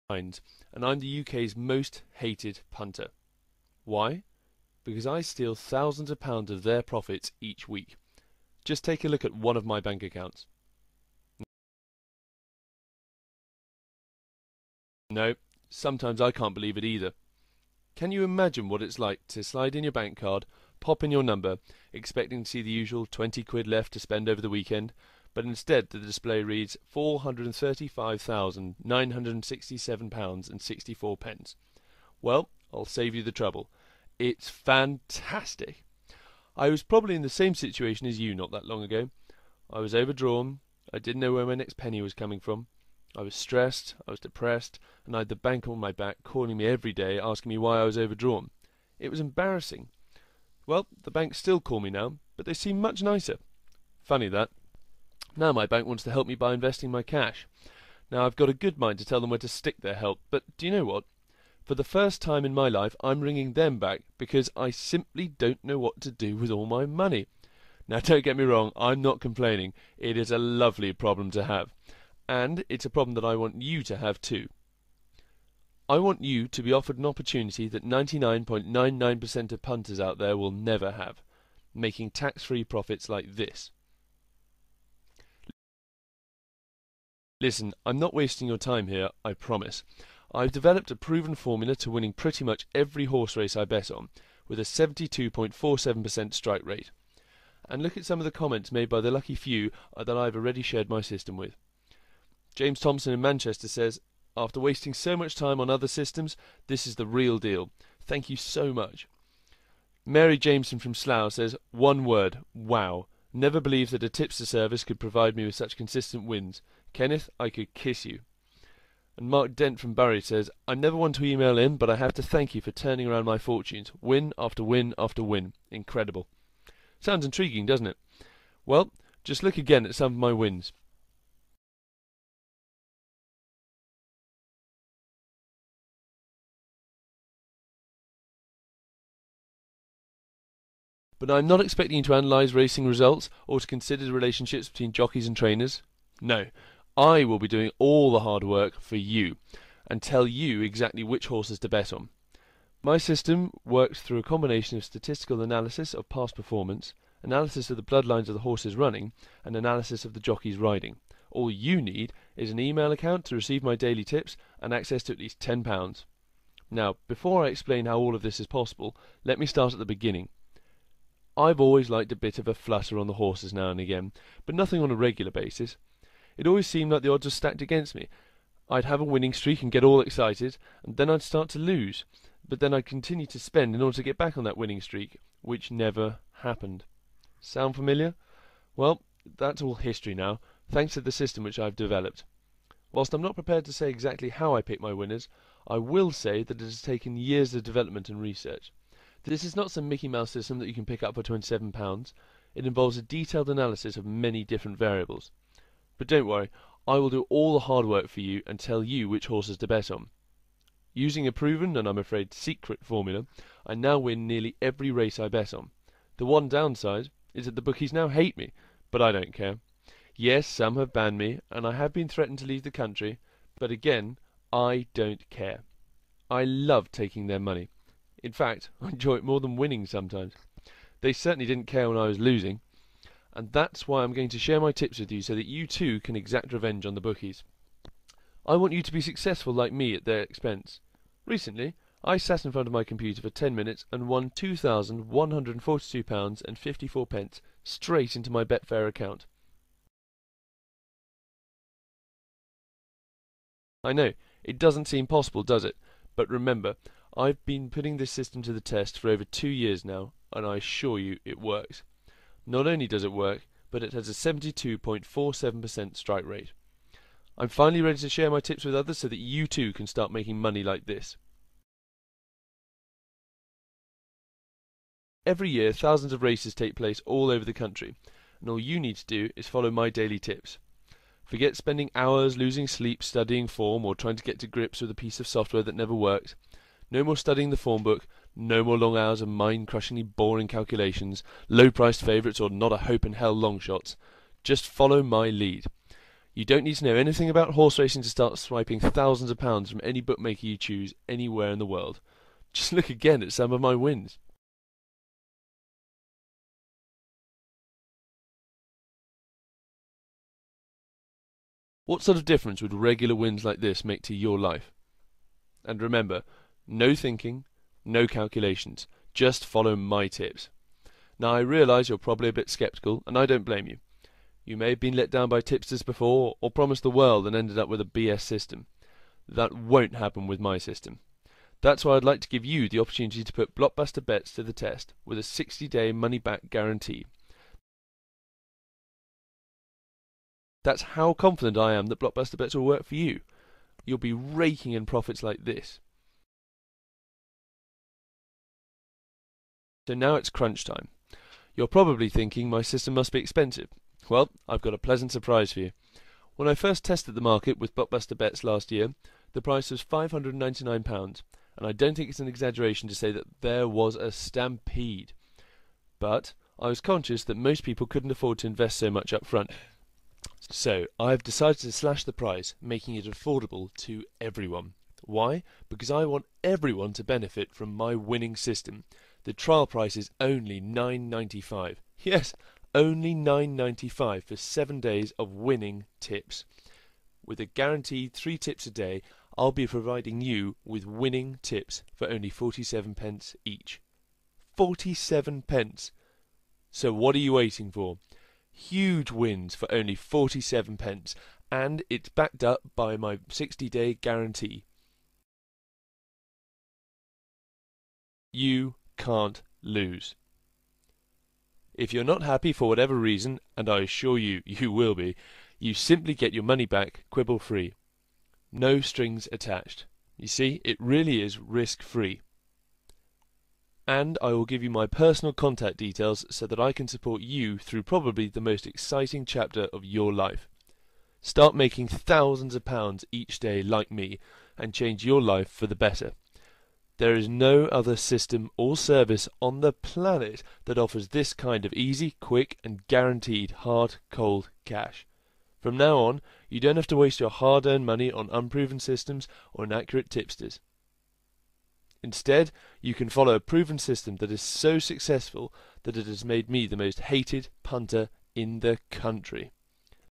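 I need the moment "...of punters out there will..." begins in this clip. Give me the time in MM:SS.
01:19.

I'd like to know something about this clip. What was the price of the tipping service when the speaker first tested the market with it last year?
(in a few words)
£599.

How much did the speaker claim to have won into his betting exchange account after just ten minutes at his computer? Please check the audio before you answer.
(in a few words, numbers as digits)
£2,142.54.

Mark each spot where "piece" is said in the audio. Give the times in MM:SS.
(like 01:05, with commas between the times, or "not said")
04:44.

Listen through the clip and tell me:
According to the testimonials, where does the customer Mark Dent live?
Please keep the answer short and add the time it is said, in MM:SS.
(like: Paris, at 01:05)
Barry, at 01:59.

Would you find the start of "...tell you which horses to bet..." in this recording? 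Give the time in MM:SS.
03:28.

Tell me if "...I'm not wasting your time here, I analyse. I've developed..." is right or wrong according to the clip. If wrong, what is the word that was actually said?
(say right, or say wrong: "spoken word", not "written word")
wrong: "promise", not "analyse".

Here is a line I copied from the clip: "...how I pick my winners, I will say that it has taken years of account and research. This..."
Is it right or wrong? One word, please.
wrong.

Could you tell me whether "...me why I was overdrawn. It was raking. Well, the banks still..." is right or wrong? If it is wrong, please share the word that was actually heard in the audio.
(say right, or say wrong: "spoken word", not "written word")
wrong: "embarrassing", not "raking".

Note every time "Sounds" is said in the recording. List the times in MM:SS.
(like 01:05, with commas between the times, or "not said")
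02:06, 03:07.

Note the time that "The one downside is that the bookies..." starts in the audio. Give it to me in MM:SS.
03:36.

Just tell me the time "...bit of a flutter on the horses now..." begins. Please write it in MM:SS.
02:52.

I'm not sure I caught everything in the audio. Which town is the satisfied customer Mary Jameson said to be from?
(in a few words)
Slough.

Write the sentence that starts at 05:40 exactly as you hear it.
That's how confident I am that blockbuster bets will work for you.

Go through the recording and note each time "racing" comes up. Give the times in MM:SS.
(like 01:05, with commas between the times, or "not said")
02:22, 04:57.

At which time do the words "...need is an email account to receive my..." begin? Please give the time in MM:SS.
02:41.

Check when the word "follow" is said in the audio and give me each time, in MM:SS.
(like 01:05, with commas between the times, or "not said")
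04:39, 04:54, 05:19, 07:33.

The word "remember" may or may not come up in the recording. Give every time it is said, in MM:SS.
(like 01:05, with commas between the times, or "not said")
04:16, 05:15.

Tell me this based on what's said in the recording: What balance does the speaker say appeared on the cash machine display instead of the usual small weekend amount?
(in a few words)
£435,967.64.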